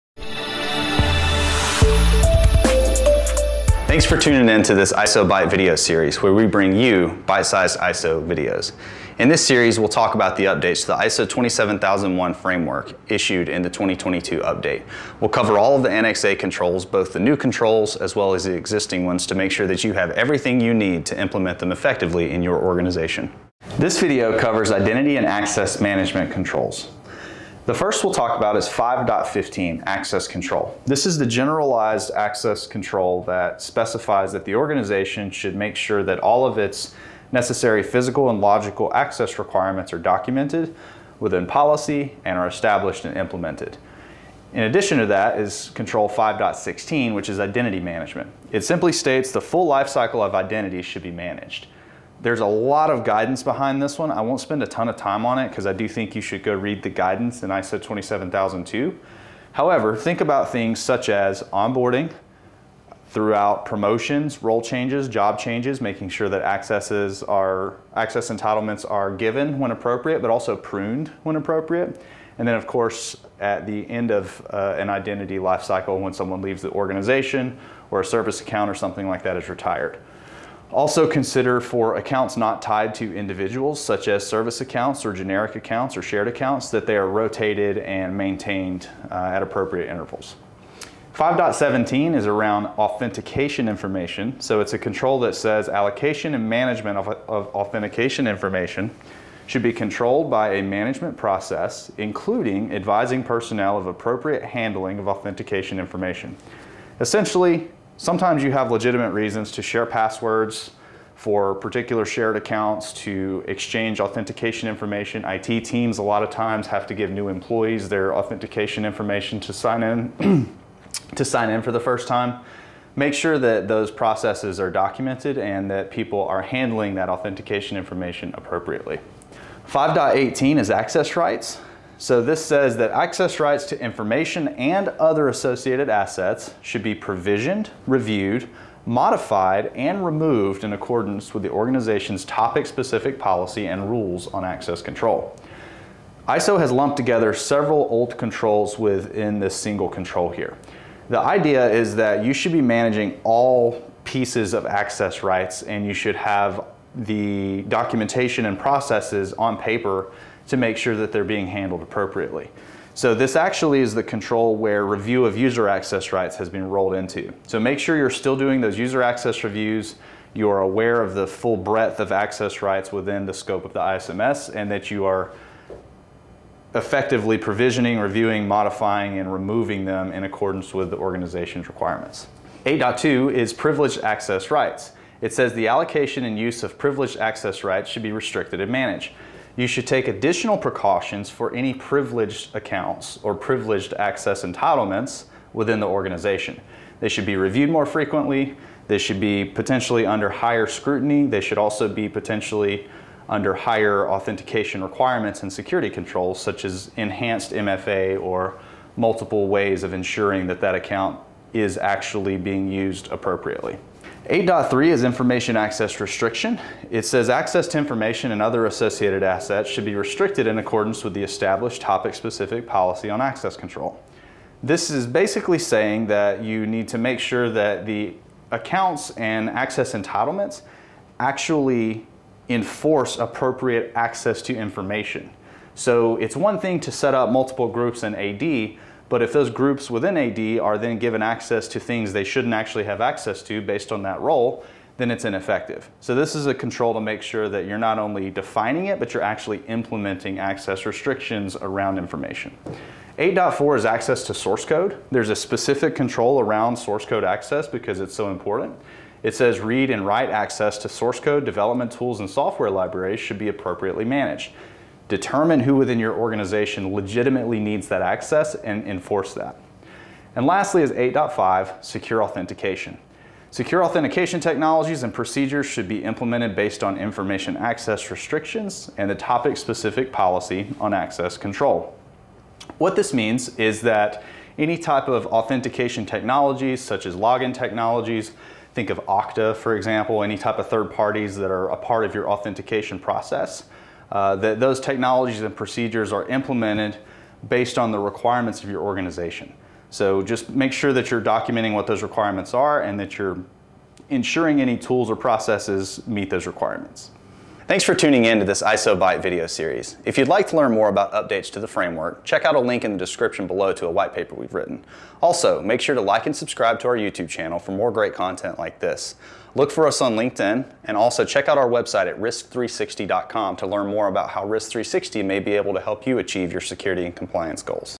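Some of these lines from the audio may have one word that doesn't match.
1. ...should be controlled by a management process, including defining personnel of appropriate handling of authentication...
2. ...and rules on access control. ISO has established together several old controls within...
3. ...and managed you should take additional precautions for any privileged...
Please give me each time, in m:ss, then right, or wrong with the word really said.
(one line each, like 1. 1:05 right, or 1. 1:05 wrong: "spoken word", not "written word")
1. 1:39 wrong: "advising", not "defining"
2. 2:23 wrong: "lumped", not "established"
3. 3:08 right.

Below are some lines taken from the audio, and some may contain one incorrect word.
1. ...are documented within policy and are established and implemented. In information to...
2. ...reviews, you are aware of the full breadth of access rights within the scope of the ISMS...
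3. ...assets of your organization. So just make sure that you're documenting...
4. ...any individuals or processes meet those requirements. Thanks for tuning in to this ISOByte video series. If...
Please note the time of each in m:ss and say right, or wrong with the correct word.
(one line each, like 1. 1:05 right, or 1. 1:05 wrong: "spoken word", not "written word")
1. 0:39 wrong: "addition", not "information"
2. 2:49 right
3. 4:57 wrong: "requirements", not "assets"
4. 5:04 wrong: "tools", not "individuals".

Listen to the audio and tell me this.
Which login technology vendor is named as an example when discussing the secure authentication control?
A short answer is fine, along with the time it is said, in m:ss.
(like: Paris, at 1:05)
Okta, at 4:48.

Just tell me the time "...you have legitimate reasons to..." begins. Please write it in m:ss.
1:48.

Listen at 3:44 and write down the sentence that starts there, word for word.
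This is basically saying that you need to make sure that the accounts and access entitlements actually enforce appropriate access to information.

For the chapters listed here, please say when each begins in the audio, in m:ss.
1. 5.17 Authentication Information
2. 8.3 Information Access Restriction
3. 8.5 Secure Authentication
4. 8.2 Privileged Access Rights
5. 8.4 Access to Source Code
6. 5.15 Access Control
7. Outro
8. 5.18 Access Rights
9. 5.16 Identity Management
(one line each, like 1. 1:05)
1. 1:30
2. 3:33
3. 4:30
4. 3:02
5. 4:13
6. 0:28
7. 5:06
8. 2:09
9. 0:45.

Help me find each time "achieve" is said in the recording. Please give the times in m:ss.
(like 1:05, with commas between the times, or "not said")
5:26.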